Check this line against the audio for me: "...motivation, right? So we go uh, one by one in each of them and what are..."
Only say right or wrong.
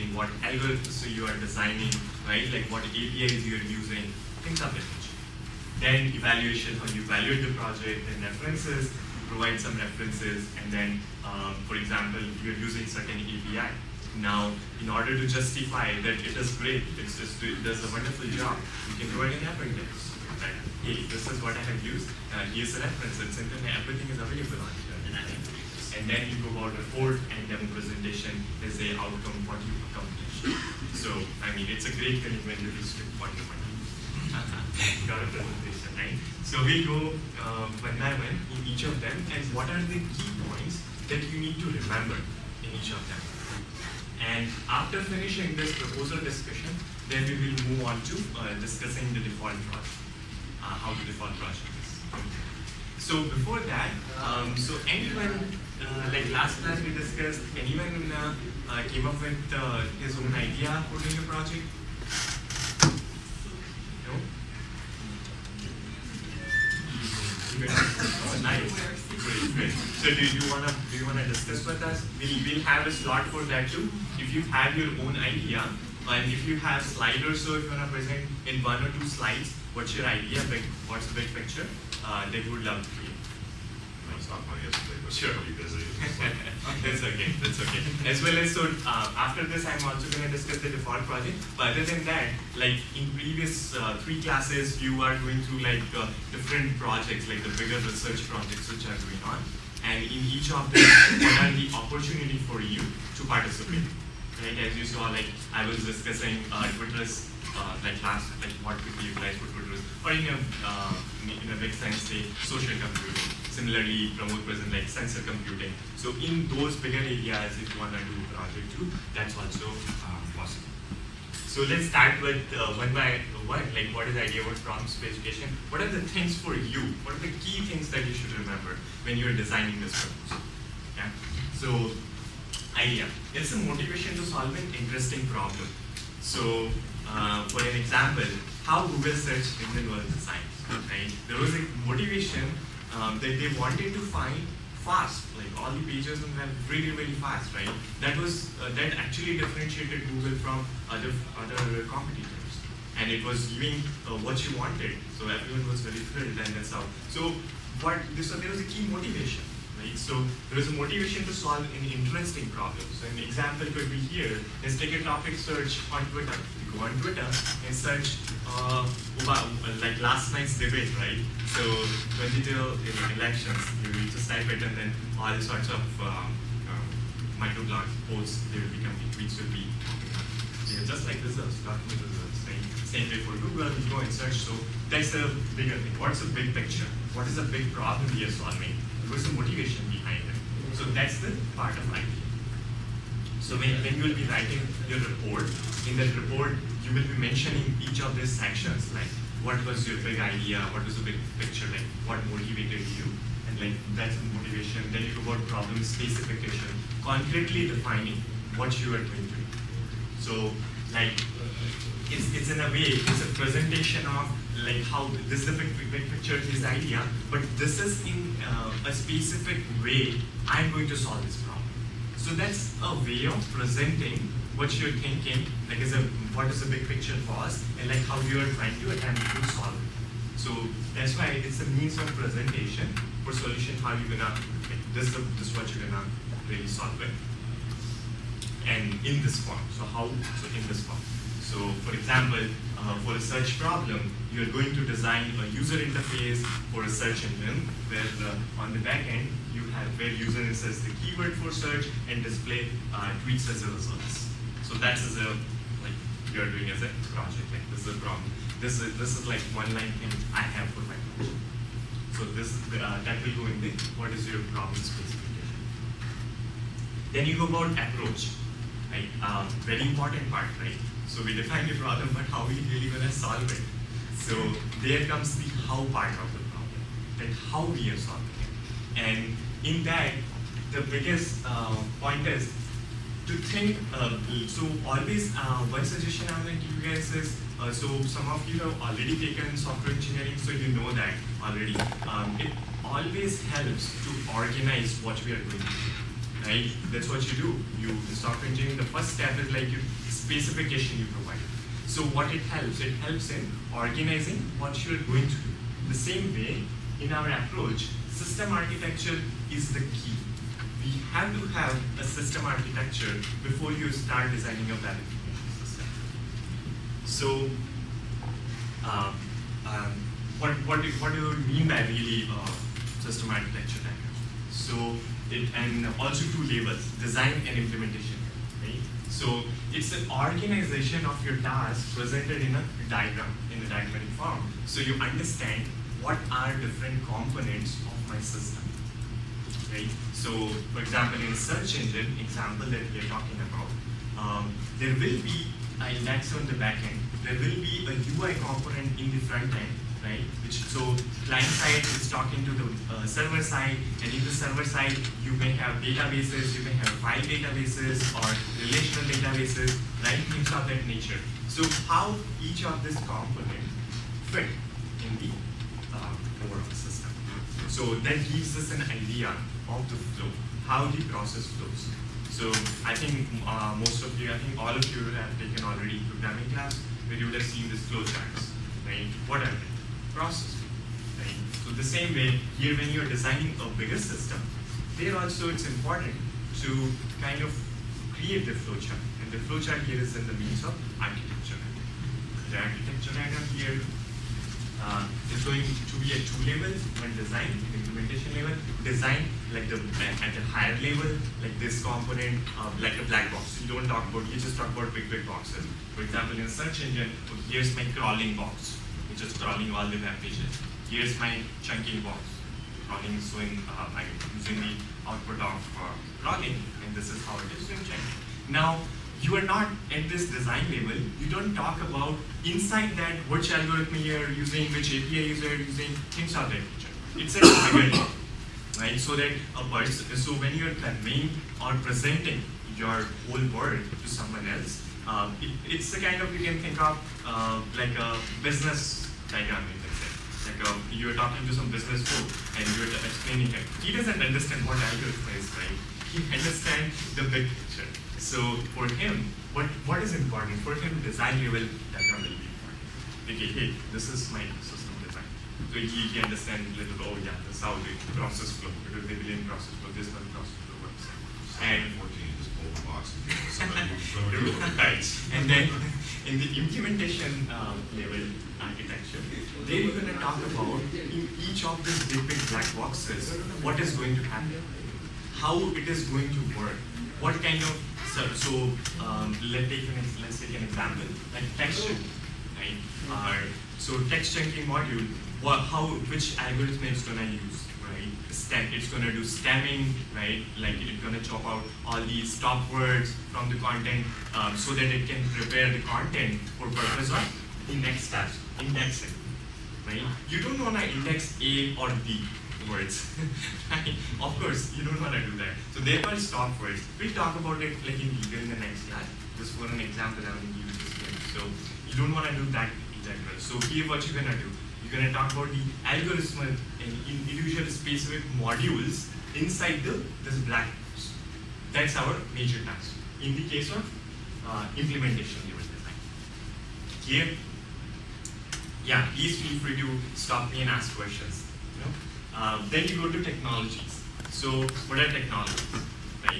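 wrong.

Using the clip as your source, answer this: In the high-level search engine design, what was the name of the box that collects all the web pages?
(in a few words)
crawling box.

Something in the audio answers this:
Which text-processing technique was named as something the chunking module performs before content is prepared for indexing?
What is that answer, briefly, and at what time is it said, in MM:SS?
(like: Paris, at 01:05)
stemming, at 08:09.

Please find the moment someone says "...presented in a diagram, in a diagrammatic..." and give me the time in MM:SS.
05:31.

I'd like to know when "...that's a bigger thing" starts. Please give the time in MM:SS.
03:04.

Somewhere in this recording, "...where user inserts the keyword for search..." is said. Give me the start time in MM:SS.
04:09.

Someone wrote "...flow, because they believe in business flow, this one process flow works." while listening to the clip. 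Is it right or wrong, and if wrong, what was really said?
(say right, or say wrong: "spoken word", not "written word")
wrong: "process", not "business".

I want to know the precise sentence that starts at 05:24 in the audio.
So it, and also two labels, design and implementation.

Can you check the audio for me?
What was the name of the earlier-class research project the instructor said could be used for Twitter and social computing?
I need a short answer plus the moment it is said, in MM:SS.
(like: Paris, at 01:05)
Twitris, at 01:46.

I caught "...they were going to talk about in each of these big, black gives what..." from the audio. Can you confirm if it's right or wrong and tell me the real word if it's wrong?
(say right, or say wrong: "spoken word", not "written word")
wrong: "boxes", not "gives".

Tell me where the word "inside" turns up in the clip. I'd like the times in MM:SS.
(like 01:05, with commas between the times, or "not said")
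07:02, 08:39.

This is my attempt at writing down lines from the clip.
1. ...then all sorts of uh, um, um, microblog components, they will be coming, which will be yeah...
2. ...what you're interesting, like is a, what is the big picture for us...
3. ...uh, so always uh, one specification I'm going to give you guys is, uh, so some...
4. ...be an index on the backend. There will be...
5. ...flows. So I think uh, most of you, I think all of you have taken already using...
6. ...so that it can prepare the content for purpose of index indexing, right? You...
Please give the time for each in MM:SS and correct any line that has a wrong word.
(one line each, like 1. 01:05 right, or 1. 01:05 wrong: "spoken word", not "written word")
1. 02:54 wrong: "posts", not "components"
2. 03:44 wrong: "thinking", not "interesting"
3. 04:43 wrong: "suggestion", not "specification"
4. 05:45 right
5. 06:11 wrong: "programming", not "using"
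6. 08:14 right.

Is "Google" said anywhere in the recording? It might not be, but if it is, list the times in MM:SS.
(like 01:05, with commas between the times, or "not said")
02:18, 02:30, 03:03.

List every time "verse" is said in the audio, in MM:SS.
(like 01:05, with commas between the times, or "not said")
not said.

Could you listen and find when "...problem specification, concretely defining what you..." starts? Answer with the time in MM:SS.
03:25.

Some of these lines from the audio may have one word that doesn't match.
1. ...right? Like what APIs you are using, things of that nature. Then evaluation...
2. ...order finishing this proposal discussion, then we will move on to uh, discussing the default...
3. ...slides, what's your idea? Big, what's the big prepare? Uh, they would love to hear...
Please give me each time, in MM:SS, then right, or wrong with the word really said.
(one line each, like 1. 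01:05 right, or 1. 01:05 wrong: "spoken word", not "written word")
1. 00:02 right
2. 00:44 wrong: "after", not "order"
3. 01:19 wrong: "picture", not "prepare".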